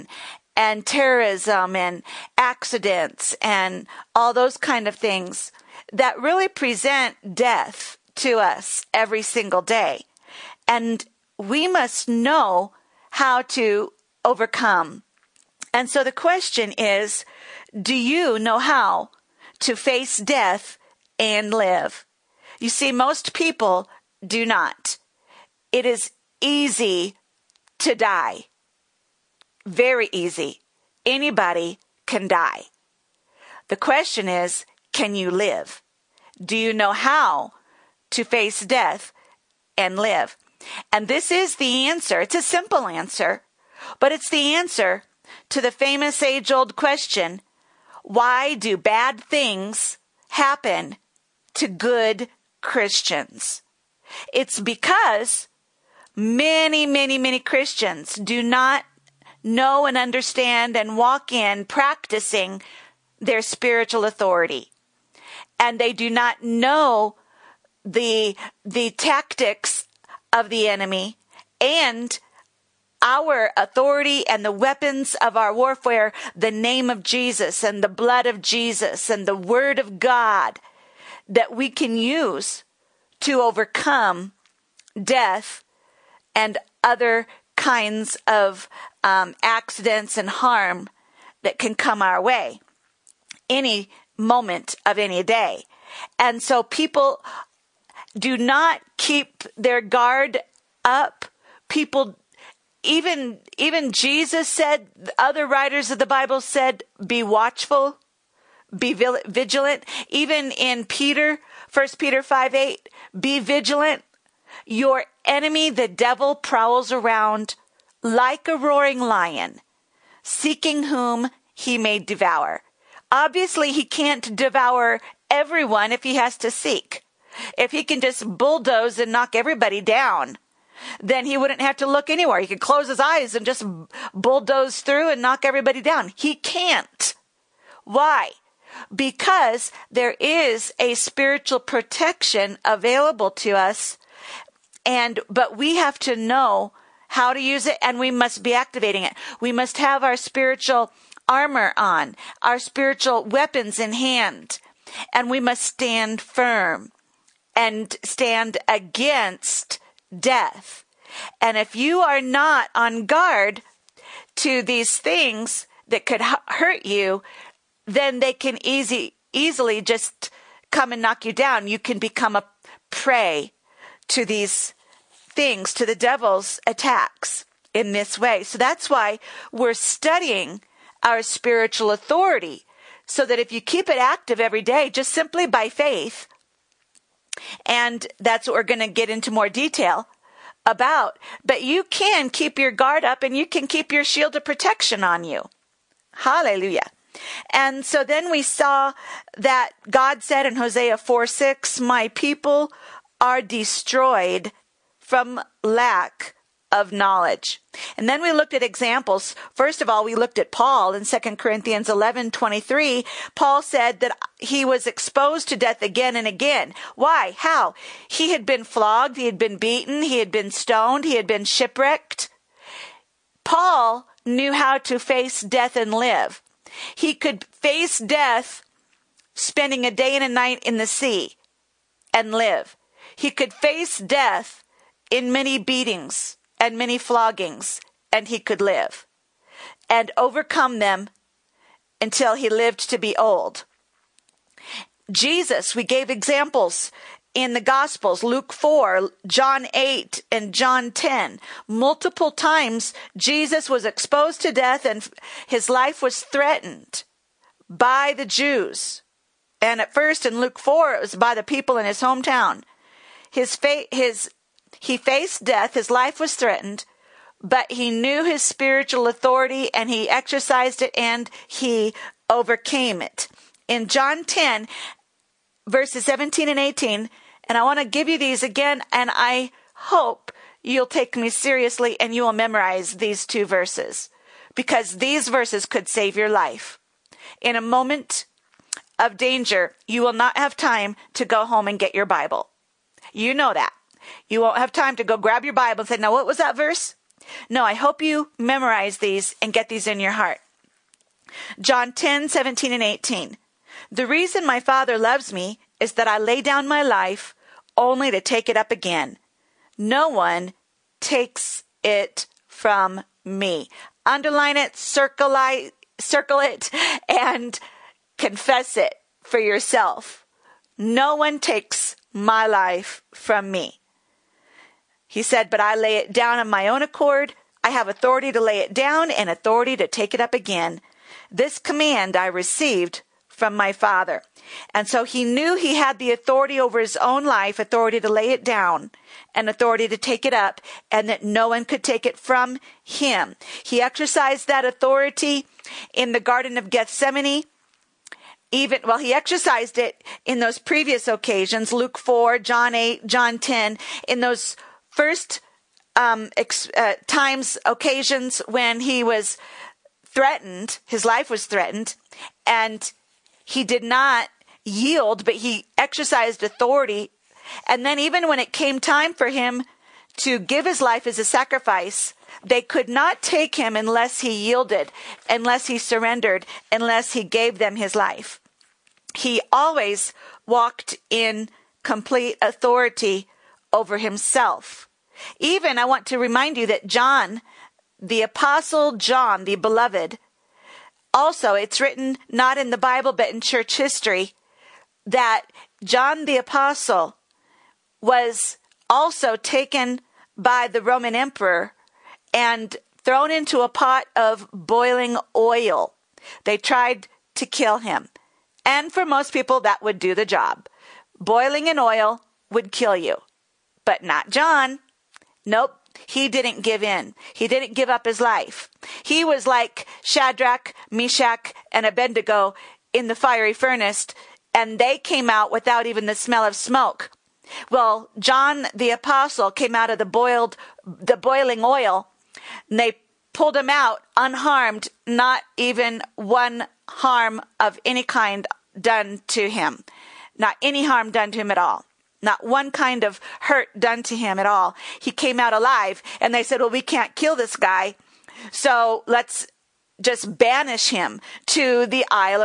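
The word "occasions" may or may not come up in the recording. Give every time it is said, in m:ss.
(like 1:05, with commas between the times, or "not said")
5:51, 5:57.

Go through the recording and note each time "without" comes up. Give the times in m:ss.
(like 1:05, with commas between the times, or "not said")
7:05.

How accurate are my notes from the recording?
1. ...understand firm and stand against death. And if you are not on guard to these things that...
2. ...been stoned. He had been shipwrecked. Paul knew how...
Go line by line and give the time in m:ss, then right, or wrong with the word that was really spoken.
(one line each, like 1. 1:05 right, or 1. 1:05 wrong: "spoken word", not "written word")
1. 2:35 wrong: "stand", not "understand"
2. 3:40 right.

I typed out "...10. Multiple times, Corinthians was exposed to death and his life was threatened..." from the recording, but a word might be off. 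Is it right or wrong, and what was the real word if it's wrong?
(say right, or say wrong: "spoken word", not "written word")
wrong: "Jesus", not "Corinthians".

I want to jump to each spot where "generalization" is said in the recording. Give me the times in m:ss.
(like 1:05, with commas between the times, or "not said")
not said.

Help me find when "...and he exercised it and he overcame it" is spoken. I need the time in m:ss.
4:29.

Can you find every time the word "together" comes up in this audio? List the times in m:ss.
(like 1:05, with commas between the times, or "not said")
not said.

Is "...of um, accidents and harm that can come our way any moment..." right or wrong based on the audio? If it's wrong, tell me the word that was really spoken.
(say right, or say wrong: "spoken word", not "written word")
right.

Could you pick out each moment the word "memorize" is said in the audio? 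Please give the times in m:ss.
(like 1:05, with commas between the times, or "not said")
4:42, 4:58.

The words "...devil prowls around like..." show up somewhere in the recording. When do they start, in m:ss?
1:55.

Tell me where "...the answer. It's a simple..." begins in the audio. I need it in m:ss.
0:41.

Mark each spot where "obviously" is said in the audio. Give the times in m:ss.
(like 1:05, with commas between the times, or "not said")
2:03.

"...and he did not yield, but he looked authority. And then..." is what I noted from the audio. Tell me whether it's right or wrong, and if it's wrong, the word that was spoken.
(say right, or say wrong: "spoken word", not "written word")
wrong: "exercised", not "looked".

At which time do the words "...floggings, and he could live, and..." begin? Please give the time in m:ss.
3:56.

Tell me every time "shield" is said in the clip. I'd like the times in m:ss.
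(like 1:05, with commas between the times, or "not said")
3:14.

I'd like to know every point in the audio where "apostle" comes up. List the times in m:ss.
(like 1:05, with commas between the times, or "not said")
6:28, 6:36, 7:08.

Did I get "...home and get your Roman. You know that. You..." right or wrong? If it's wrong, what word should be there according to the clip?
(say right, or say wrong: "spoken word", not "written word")
wrong: "Bible", not "Roman".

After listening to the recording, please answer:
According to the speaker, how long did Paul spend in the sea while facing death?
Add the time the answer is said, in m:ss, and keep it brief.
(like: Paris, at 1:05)
a day and a night, at 3:49.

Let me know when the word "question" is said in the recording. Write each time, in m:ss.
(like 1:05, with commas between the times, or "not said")
0:16, 0:33, 0:46.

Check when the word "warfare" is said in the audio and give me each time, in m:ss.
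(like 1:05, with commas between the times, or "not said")
1:15.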